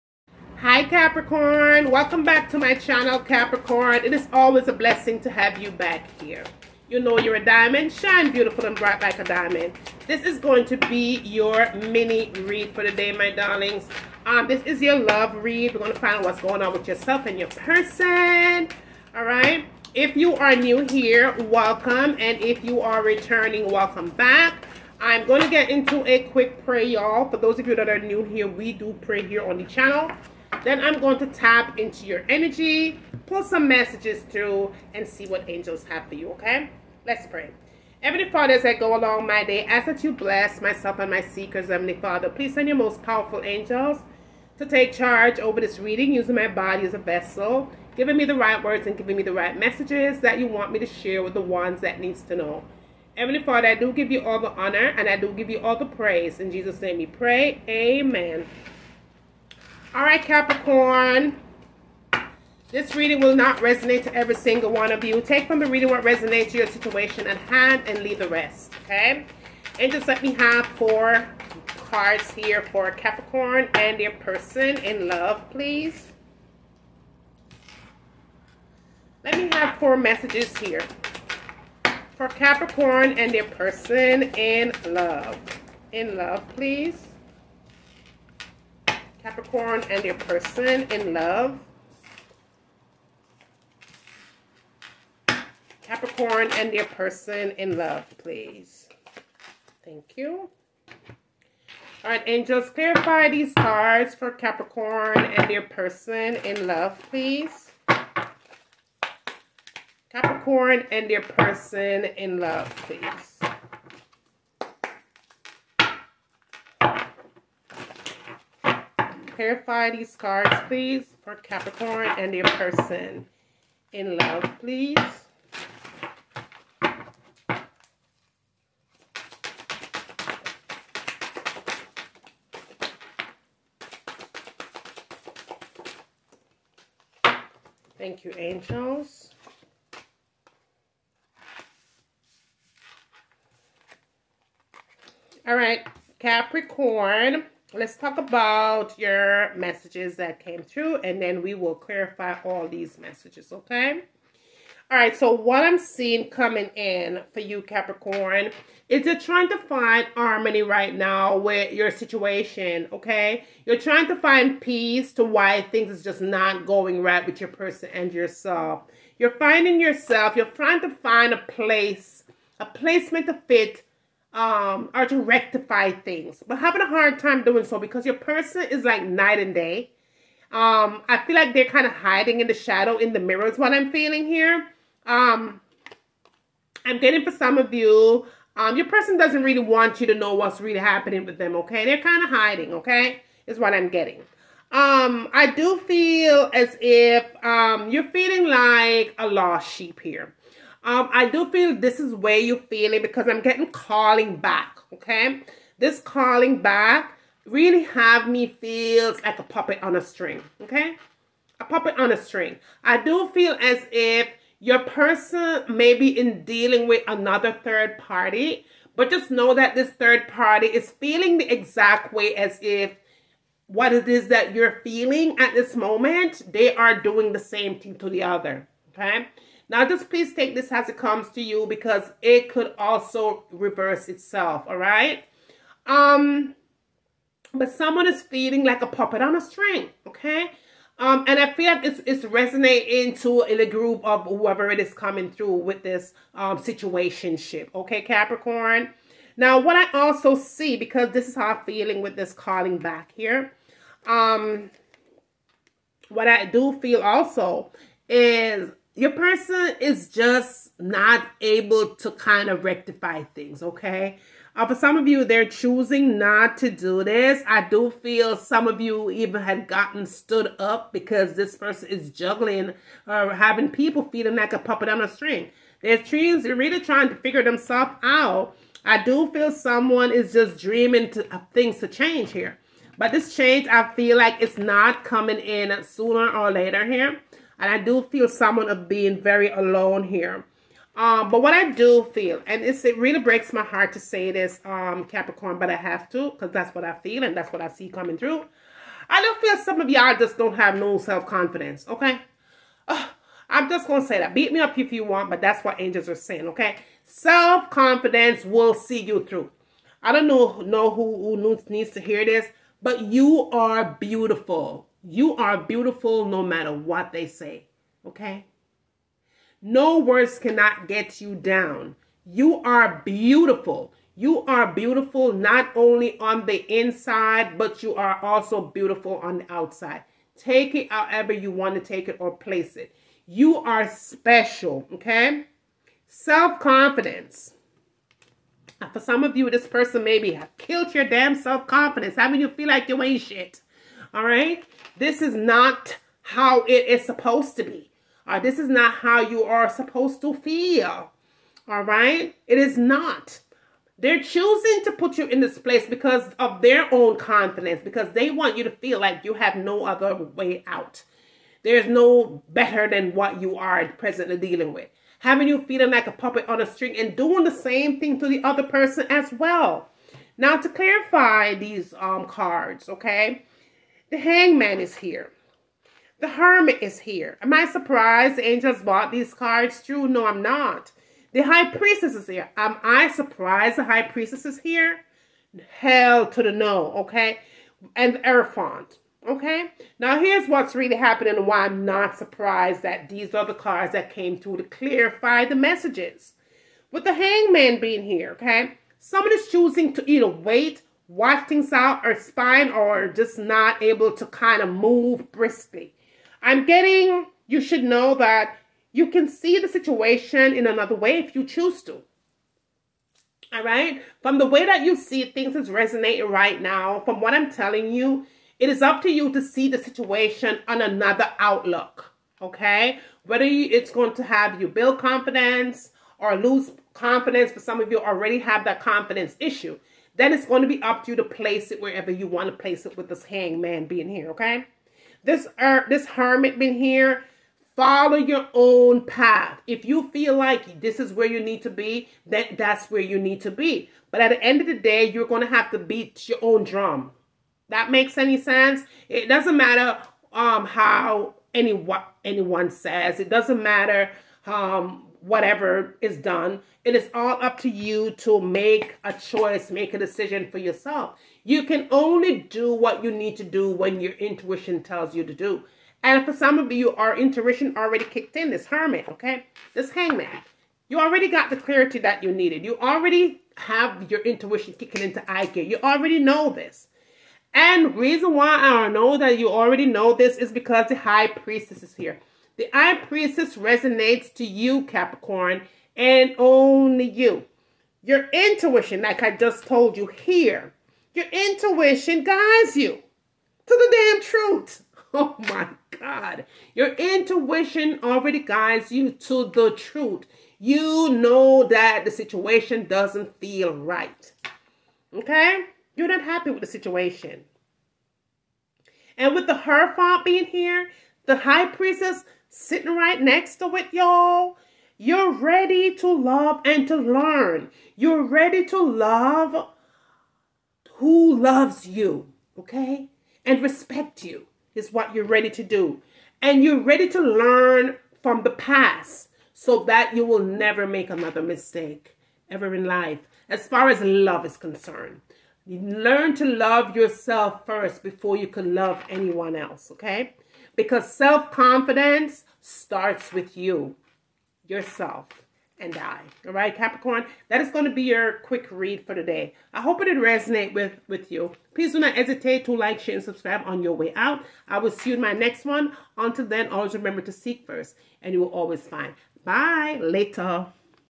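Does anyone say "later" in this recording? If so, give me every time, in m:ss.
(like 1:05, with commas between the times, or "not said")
4:46, 9:20.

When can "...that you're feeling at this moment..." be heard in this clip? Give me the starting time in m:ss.
3:44.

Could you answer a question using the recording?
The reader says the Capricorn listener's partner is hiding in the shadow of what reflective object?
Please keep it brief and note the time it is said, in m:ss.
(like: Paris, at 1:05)
the mirror, at 3:03.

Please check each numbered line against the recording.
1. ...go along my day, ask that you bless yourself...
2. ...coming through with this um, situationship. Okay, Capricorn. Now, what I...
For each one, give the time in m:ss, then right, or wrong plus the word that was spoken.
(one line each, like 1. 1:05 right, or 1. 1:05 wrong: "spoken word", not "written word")
1. 0:38 wrong: "myself", not "yourself"
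2. 4:04 right.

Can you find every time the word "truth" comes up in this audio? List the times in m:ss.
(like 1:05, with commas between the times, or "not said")
8:14, 8:19.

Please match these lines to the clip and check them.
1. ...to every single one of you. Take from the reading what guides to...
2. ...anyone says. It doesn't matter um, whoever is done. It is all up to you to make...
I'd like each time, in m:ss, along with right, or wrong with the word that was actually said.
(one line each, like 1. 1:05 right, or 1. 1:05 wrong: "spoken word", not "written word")
1. 1:04 wrong: "resonates", not "guides"
2. 7:32 wrong: "whatever", not "whoever".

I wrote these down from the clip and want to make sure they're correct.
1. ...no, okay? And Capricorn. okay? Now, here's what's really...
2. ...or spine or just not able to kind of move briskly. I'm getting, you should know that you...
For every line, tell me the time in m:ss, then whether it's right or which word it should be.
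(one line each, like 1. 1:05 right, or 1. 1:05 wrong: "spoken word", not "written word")
1. 6:26 wrong: "Hierophant", not "Capricorn"
2. 6:42 right.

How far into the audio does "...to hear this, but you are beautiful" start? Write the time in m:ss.
5:11.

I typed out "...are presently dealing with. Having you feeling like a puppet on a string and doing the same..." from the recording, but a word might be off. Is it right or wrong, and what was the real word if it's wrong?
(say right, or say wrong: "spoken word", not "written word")
right.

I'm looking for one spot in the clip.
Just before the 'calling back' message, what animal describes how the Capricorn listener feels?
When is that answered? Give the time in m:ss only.
3:19.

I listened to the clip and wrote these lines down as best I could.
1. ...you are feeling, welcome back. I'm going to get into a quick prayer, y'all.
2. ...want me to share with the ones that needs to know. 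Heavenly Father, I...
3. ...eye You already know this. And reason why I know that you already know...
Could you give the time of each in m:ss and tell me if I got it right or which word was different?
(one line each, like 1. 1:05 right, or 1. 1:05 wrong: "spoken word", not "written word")
1. 0:22 wrong: "returning", not "feeling"
2. 0:50 right
3. 7:55 right.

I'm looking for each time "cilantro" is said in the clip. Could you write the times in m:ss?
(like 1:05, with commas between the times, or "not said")
not said.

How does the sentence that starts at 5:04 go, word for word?
Beat me up if you want, but that's what angels are saying, okay?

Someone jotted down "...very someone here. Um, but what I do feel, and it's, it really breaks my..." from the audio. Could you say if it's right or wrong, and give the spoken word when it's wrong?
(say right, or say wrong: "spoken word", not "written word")
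wrong: "alone", not "someone".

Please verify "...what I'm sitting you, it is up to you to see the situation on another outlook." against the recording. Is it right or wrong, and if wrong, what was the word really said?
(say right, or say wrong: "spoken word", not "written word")
wrong: "telling", not "sitting".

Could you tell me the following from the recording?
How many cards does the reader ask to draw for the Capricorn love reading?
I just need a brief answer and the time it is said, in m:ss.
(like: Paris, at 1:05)
4, at 1:10.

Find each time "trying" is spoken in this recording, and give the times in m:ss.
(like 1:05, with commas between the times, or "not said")
2:39, 2:43, 2:50, 4:36.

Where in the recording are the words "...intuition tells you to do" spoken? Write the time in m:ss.
7:44.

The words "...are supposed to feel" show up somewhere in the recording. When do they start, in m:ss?
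5:49.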